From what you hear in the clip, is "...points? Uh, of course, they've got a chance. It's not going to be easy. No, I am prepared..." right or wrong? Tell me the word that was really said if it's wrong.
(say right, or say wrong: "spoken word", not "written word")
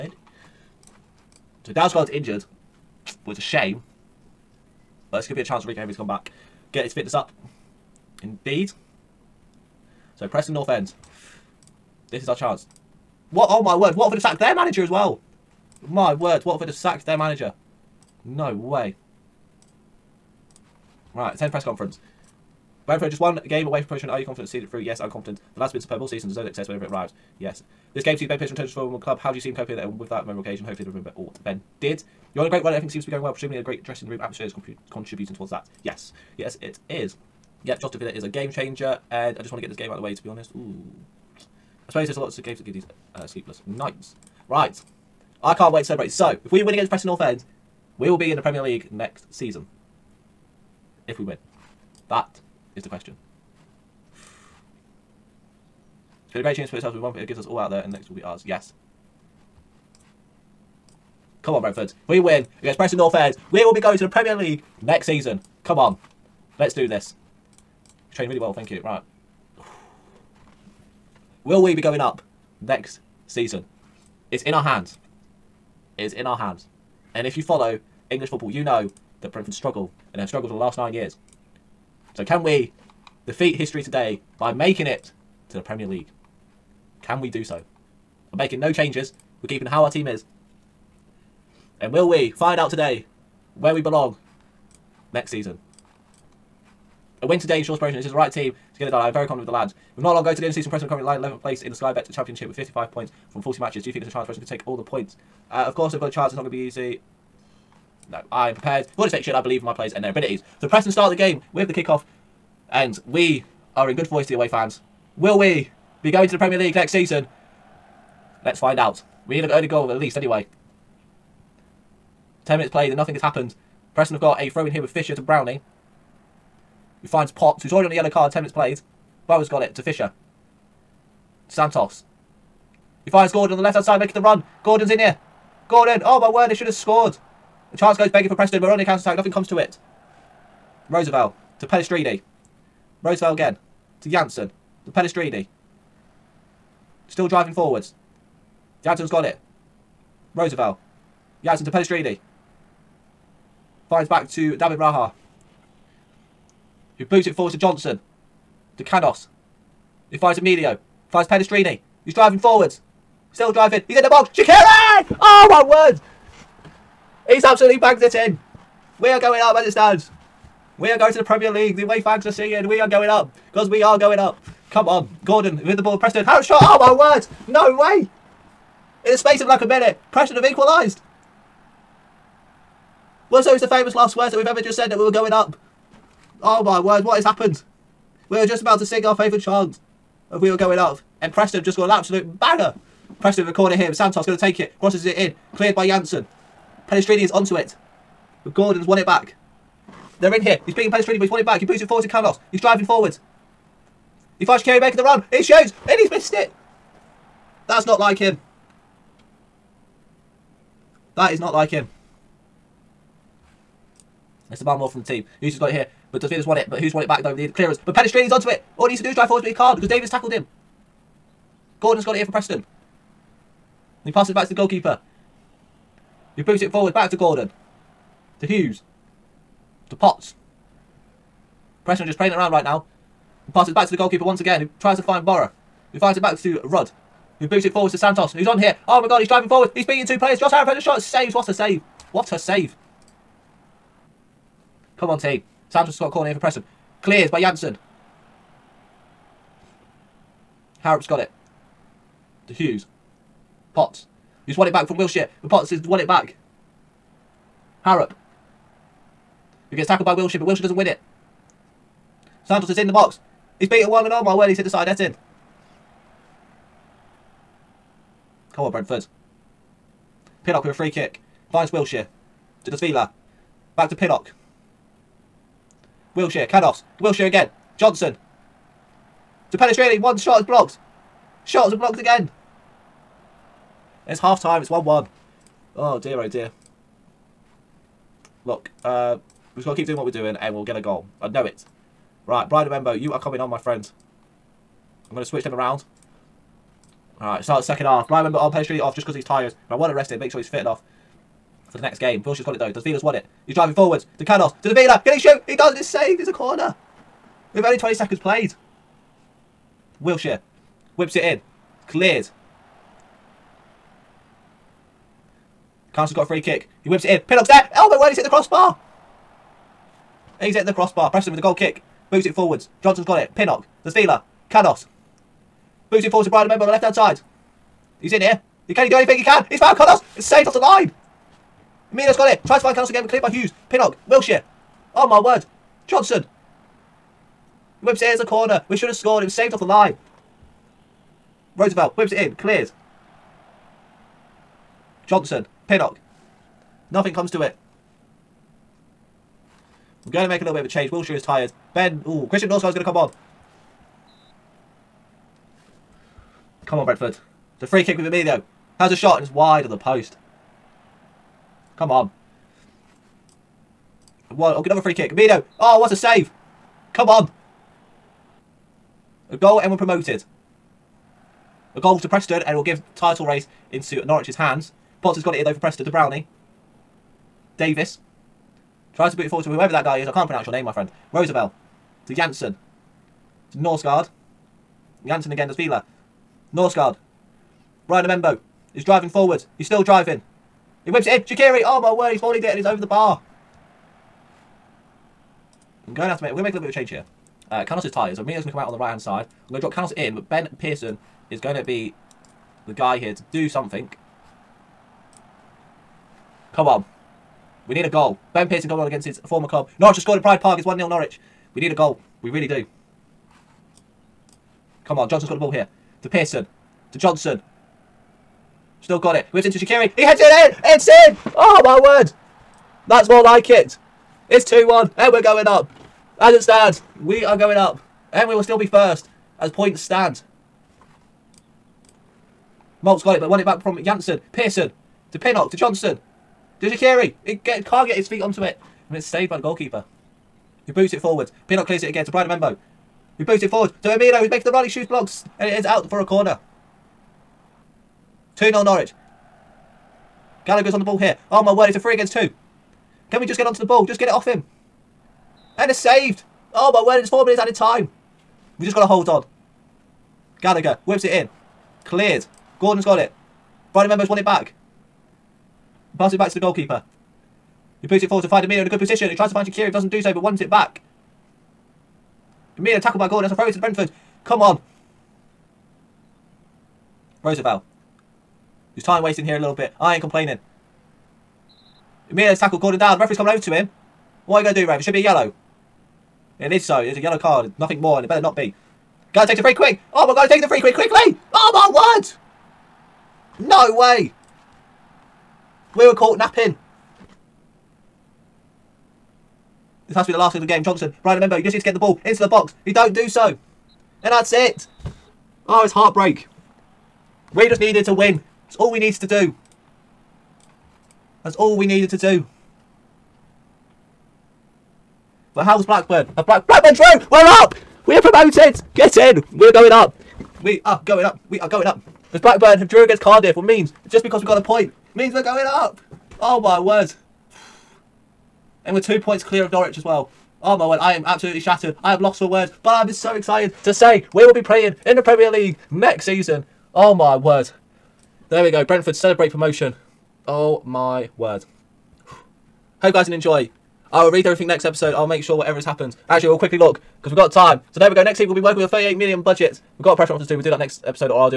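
right.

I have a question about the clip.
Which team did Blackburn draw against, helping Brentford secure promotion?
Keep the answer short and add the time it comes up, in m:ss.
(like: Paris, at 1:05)
Cardiff, at 8:43.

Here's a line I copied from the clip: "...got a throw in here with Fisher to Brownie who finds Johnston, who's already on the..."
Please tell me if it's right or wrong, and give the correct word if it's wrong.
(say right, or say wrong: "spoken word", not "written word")
wrong: "Potts", not "Johnston".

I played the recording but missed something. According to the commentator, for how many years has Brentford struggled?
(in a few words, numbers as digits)
9.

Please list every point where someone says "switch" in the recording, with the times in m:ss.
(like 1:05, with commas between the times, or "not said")
4:55.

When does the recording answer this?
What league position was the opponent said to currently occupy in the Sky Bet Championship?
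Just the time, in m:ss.
1:41.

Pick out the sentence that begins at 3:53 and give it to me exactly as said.
And passes back to the goalkeeper once again, who tries to find Borough.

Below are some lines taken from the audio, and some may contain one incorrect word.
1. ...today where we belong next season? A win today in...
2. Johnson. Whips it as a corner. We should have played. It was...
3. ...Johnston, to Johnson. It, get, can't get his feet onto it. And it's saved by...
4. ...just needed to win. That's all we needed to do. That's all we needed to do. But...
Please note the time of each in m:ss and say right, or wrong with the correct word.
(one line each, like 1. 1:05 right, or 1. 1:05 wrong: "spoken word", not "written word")
1. 1:32 right
2. 5:35 wrong: "scored", not "played"
3. 7:15 wrong: "Shaqiri", not "Johnson"
4. 8:27 right.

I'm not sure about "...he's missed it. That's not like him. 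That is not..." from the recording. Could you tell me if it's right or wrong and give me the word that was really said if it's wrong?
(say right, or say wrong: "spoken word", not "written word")
right.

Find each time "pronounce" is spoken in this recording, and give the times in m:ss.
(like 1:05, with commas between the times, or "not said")
6:20.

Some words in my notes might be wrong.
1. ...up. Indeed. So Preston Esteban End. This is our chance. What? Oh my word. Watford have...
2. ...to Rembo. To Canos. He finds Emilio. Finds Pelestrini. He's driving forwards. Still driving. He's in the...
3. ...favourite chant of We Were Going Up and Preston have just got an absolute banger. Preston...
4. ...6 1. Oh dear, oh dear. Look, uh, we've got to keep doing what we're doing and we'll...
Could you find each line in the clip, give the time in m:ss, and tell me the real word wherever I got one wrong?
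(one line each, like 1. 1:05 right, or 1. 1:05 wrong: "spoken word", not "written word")
1. 0:07 wrong: "North", not "Esteban"
2. 2:37 wrong: "Johnson", not "Rembo"
3. 3:09 right
4. 4:44 wrong: "1", not "6".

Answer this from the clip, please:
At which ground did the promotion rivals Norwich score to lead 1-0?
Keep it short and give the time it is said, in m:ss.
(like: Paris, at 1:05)
Pride Park, at 6:50.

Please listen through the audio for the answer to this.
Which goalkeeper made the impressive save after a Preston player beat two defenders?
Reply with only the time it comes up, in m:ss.
4:00.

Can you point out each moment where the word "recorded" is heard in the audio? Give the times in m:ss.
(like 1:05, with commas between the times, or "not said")
3:13.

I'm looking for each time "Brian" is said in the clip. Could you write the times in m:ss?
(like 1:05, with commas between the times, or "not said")
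4:52, 4:58.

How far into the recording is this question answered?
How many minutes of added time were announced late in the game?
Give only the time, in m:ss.
7:37.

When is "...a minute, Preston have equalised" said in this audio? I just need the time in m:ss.
2:59.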